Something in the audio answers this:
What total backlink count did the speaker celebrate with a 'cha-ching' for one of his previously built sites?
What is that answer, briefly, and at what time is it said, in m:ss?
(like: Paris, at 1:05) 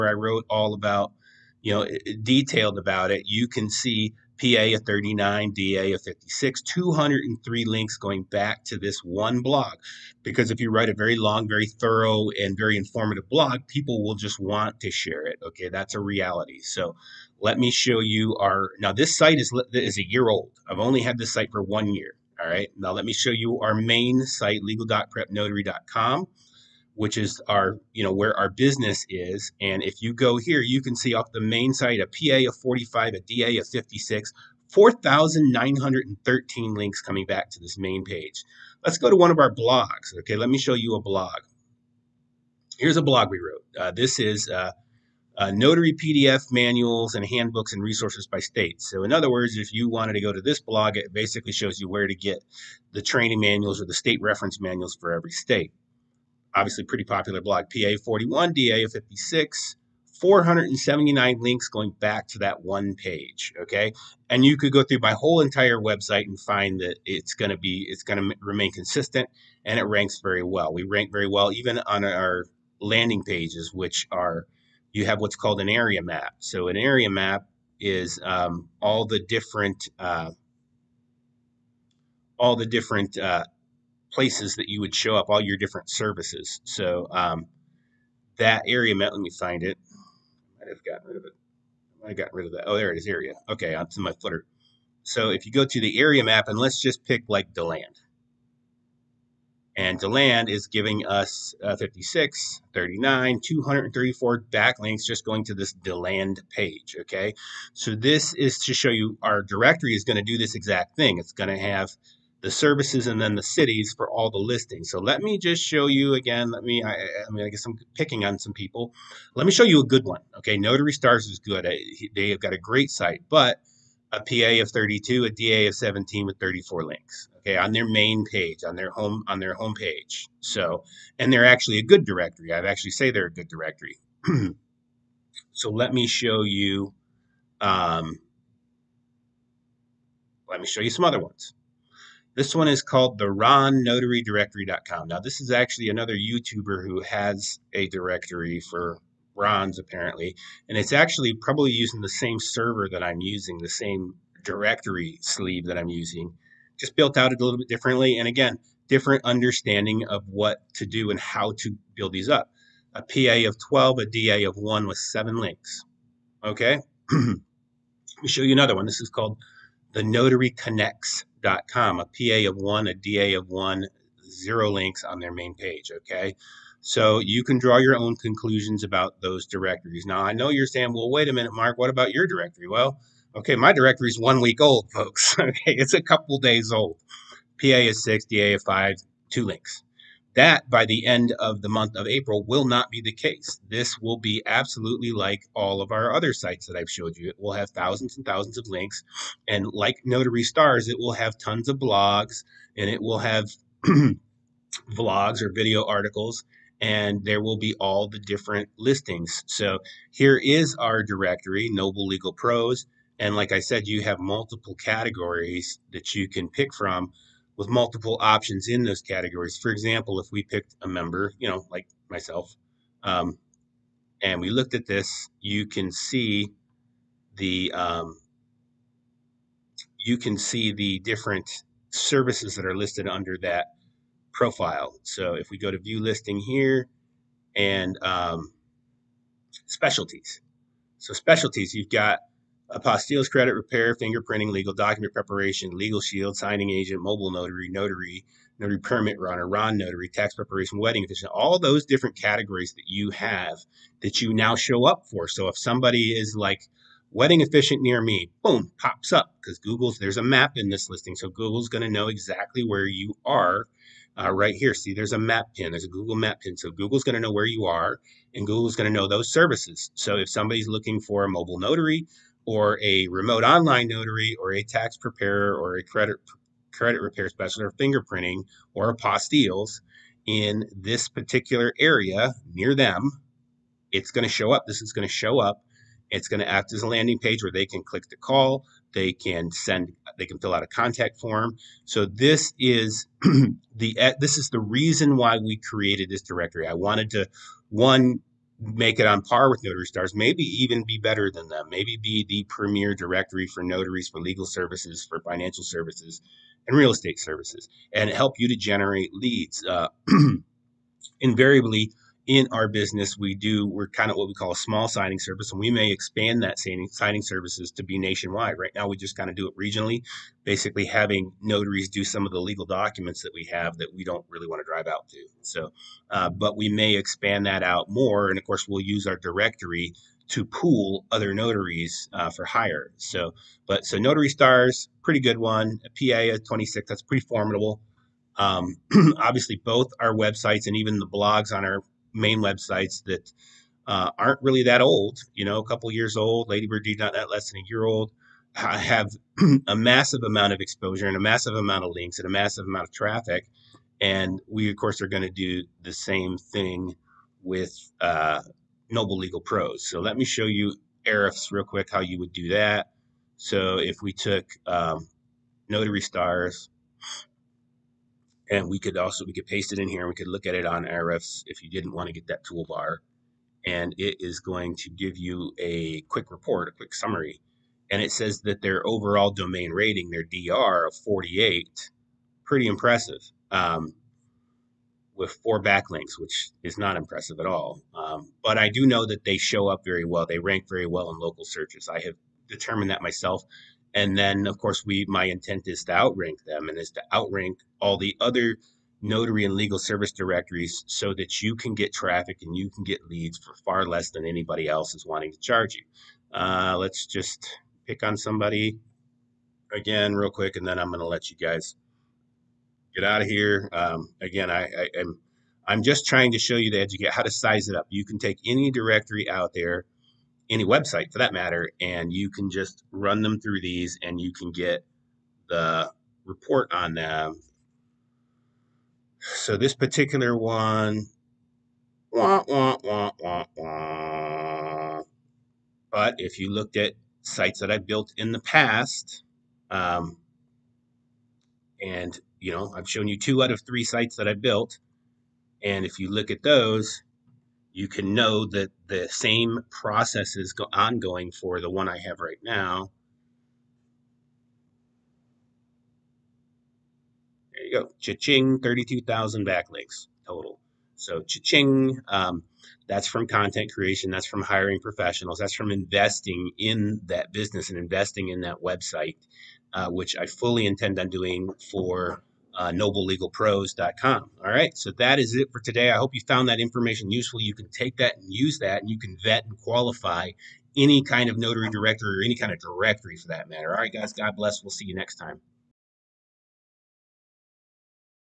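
32,000, at 7:38.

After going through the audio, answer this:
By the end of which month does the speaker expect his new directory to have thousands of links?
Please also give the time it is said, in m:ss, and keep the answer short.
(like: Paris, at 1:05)
April, at 3:12.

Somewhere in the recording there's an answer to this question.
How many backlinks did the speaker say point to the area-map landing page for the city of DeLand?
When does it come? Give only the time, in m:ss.
1:43.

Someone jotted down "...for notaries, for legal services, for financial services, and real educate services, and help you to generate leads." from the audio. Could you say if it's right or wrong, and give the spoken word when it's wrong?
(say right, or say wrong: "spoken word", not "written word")
wrong: "estate", not "educate".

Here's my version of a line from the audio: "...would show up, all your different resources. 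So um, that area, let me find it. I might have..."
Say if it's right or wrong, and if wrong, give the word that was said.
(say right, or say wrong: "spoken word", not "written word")
wrong: "services", not "resources".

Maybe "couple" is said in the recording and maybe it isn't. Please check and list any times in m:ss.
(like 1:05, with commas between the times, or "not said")
3:06, 5:45.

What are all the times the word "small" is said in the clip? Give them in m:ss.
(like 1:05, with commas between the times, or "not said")
5:14.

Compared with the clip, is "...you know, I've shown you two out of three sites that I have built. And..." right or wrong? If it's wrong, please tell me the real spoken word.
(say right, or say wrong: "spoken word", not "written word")
right.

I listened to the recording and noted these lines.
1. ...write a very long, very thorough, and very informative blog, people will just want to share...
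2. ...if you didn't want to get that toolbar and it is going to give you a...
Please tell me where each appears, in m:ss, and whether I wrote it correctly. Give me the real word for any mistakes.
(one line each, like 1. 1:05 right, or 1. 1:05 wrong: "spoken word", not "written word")
1. 0:10 right
2. 6:11 right.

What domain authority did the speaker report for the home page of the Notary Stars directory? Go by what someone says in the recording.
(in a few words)
17.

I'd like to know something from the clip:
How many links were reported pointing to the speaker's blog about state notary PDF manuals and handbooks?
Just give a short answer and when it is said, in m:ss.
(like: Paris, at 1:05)
479, at 1:00.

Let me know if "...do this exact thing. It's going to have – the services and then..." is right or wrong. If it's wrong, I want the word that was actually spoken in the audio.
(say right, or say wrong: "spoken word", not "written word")
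right.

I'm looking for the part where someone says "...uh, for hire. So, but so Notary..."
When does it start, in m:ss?
5:32.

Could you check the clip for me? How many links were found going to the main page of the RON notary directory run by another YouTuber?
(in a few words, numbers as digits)
7.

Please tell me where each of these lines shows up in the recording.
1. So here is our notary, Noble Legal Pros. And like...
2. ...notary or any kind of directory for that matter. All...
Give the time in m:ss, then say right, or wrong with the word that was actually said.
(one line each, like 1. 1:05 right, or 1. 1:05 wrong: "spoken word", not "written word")
1. 3:29 wrong: "directory", not "notary"
2. 8:01 wrong: "directory", not "notary".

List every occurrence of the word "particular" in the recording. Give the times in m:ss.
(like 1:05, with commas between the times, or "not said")
4:41, 7:09.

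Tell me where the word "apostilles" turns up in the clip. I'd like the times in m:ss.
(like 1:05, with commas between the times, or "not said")
4:02, 4:38.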